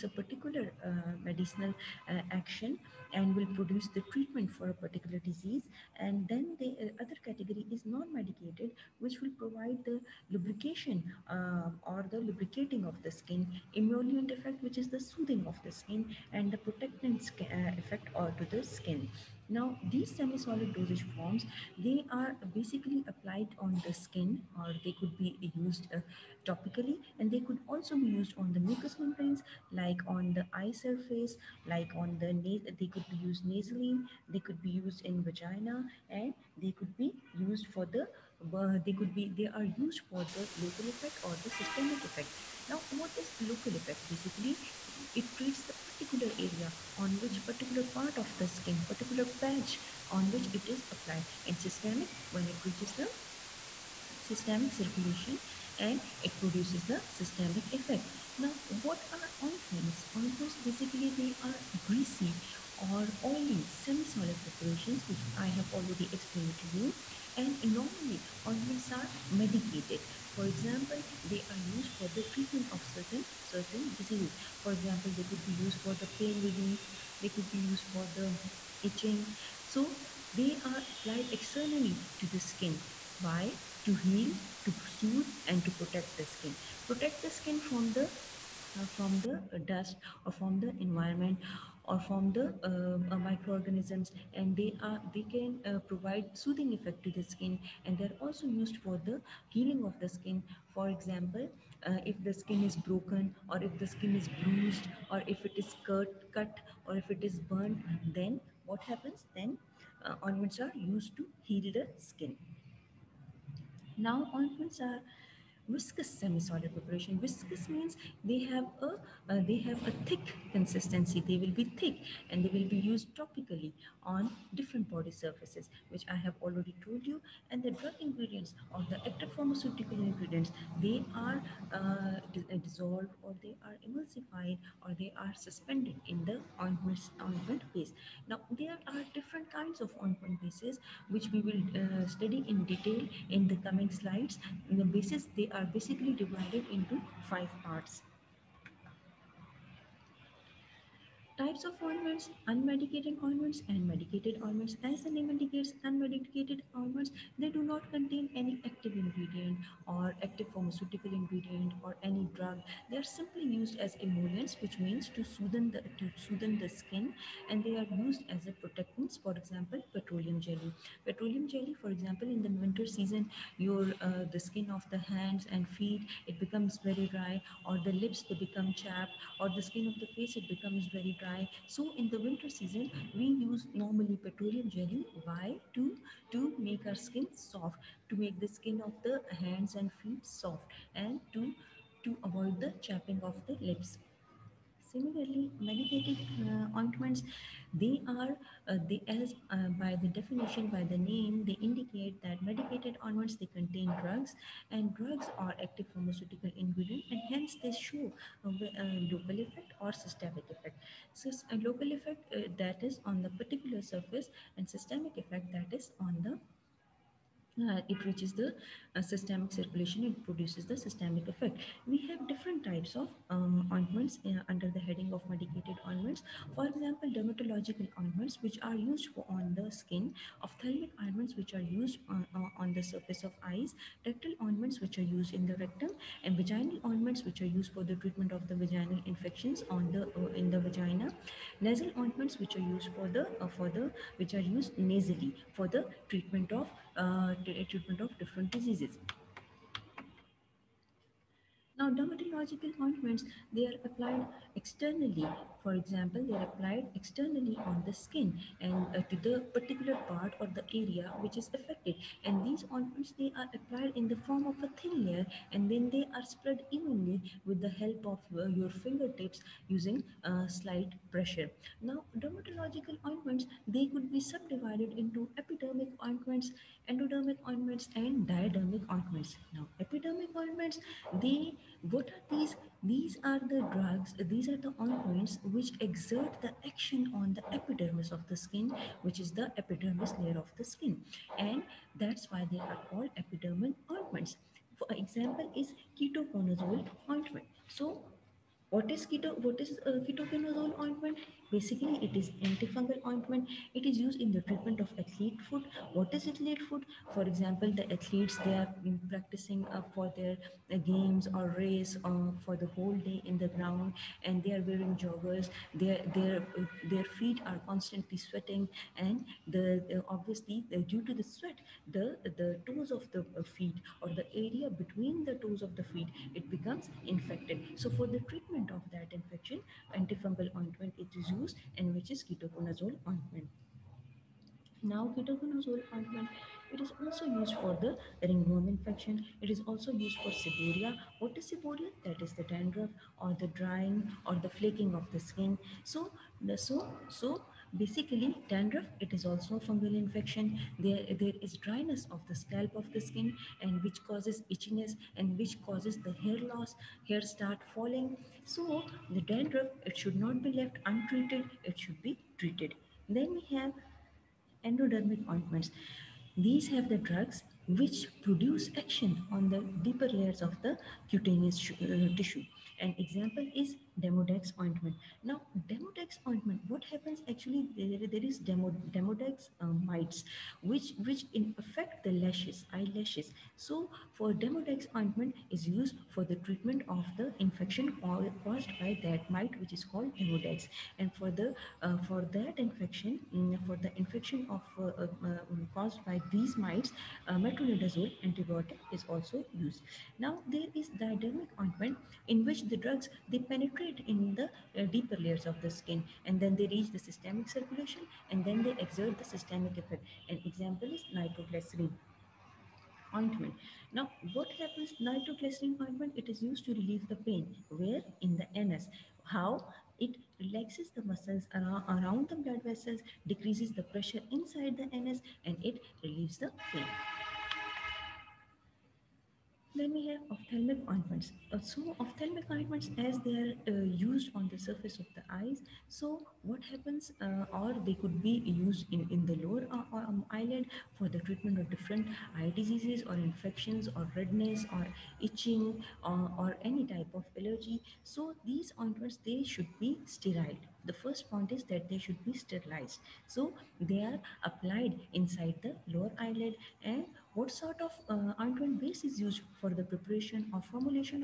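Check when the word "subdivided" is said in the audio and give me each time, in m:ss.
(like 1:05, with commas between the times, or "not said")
4:34.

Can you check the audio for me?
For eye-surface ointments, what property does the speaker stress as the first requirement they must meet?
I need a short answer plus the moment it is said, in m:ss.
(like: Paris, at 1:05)
Sterile, at 7:30.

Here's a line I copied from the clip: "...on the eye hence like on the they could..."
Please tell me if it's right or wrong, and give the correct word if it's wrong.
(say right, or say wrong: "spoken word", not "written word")
wrong: "surface", not "hence".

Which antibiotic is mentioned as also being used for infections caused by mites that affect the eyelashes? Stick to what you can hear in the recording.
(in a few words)
Metronidazole.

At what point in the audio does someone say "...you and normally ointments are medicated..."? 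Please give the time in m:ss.
1:06.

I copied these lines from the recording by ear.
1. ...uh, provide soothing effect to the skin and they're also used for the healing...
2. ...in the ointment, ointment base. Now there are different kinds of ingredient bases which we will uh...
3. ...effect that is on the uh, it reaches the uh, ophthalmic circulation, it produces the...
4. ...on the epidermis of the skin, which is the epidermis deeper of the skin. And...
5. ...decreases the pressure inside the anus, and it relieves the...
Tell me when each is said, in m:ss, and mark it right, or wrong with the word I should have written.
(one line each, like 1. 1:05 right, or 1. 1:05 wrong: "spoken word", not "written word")
1. 1:35 right
2. 2:16 wrong: "ointment", not "ingredient"
3. 3:35 wrong: "systemic", not "ophthalmic"
4. 4:47 wrong: "layer", not "deeper"
5. 7:03 right.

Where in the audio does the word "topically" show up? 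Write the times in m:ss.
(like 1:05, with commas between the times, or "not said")
0:26, 2:03.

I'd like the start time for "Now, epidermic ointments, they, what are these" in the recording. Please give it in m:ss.
4:39.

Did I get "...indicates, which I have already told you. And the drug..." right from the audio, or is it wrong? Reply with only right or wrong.
wrong.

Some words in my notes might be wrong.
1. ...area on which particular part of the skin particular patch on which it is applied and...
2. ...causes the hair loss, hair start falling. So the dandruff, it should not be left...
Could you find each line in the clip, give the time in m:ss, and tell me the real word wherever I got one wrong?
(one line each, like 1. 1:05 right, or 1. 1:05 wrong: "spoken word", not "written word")
1. 0:46 right
2. 5:55 right.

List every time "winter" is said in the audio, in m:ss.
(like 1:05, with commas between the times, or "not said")
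2:52, 3:02.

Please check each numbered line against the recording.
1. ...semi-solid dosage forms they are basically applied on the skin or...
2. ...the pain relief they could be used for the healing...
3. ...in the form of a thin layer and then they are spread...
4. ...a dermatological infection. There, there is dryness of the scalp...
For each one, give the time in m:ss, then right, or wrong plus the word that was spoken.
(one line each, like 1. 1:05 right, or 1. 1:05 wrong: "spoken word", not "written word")
1. 0:20 right
2. 1:15 wrong: "itching", not "healing"
3. 4:23 right
4. 5:49 wrong: "fungal", not "dermatological".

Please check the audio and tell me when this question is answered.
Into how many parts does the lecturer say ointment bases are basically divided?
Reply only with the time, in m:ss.
2:27.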